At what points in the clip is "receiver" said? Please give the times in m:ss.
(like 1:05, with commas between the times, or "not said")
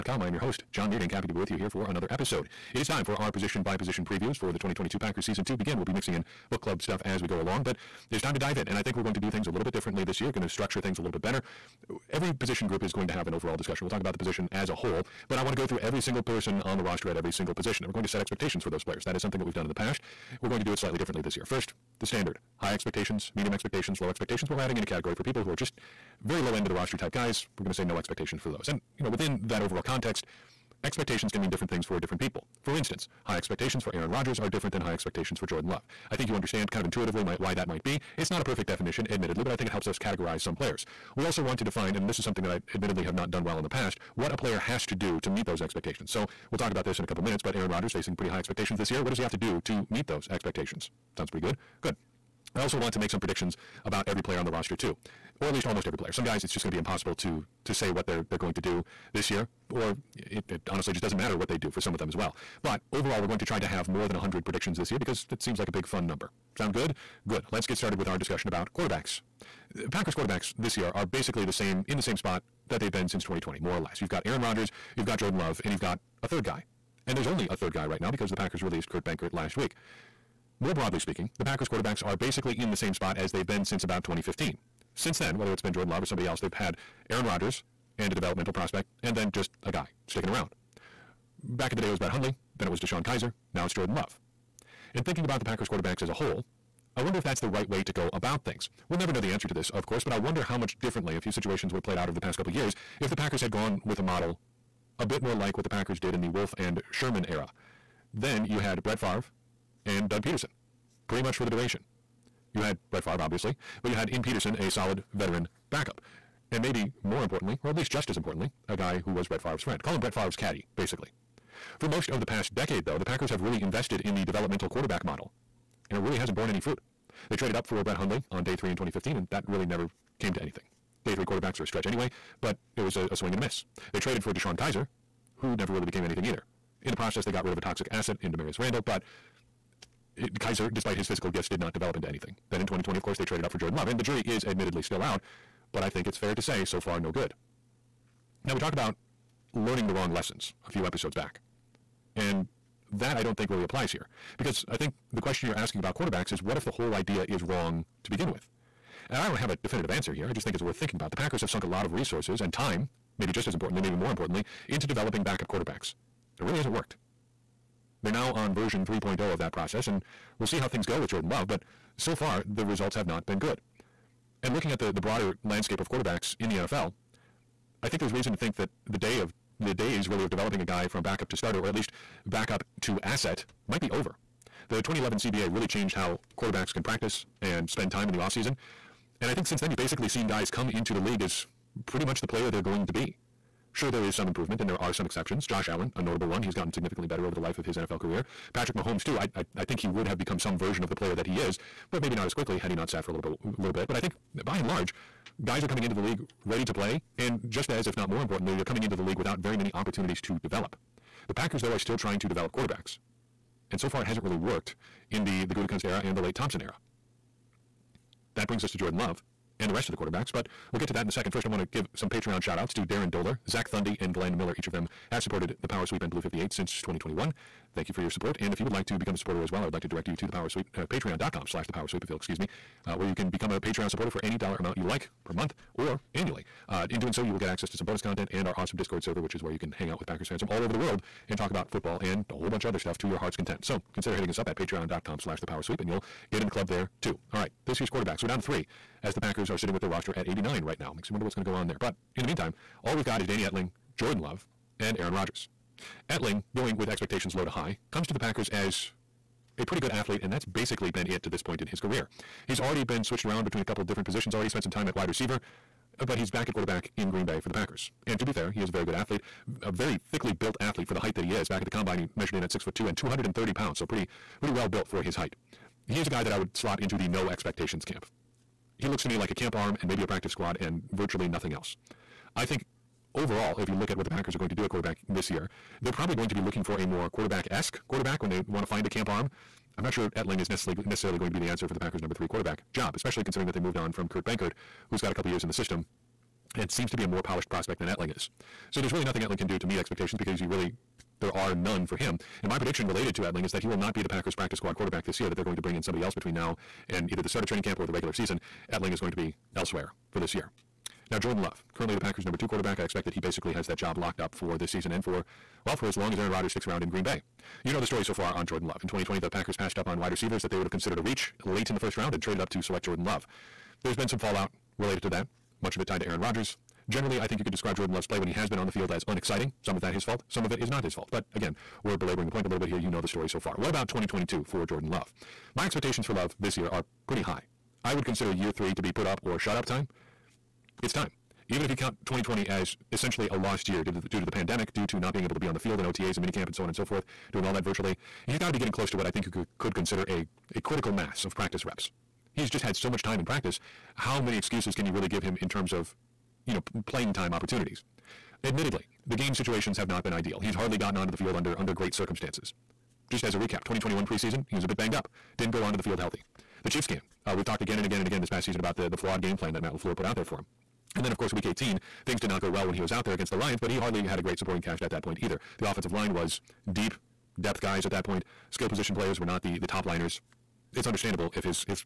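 4:25, 5:20.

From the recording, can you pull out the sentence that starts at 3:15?
Josh Allen, a notable one, he's gotten significantly better over the life of his NFL career.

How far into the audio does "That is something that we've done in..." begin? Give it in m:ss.
0:19.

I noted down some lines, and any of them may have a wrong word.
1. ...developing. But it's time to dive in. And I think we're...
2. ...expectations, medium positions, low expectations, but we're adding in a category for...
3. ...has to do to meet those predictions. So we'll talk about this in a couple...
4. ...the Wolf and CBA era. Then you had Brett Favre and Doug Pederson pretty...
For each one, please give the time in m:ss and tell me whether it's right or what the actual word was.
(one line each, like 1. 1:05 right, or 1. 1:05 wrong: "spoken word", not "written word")
1. 0:07 wrong: "along", not "developing"
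2. 0:22 wrong: "expectations", not "positions"
3. 0:44 wrong: "expectations", not "predictions"
4. 1:46 wrong: "Sherman", not "CBA".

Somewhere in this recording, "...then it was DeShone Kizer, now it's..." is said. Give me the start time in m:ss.
1:32.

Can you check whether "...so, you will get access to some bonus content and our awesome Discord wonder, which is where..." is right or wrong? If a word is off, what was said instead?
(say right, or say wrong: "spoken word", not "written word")
wrong: "server", not "wonder".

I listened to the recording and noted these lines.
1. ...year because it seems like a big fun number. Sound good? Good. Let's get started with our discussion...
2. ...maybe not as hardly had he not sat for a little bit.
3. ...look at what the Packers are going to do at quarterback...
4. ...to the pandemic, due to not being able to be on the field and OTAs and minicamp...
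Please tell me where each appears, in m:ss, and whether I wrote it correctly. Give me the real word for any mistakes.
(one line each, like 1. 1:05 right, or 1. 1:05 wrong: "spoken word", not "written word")
1. 1:04 right
2. 3:21 wrong: "quickly", not "hardly"
3. 4:43 right
4. 5:44 right.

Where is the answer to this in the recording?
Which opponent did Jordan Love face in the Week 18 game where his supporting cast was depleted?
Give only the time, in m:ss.
6:13.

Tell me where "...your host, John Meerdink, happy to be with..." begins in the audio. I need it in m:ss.
0:00.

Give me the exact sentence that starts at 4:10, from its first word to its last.
Makes you wonder what's going to go on there.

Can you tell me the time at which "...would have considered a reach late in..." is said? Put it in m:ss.
5:20.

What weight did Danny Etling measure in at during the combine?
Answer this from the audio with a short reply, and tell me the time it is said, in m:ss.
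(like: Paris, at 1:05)
230 pounds, at 4:32.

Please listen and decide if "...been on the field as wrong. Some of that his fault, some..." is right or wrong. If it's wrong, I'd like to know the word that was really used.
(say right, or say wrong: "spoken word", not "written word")
wrong: "unexciting", not "wrong".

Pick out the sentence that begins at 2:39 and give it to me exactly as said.
And I don't have a definitive answer here.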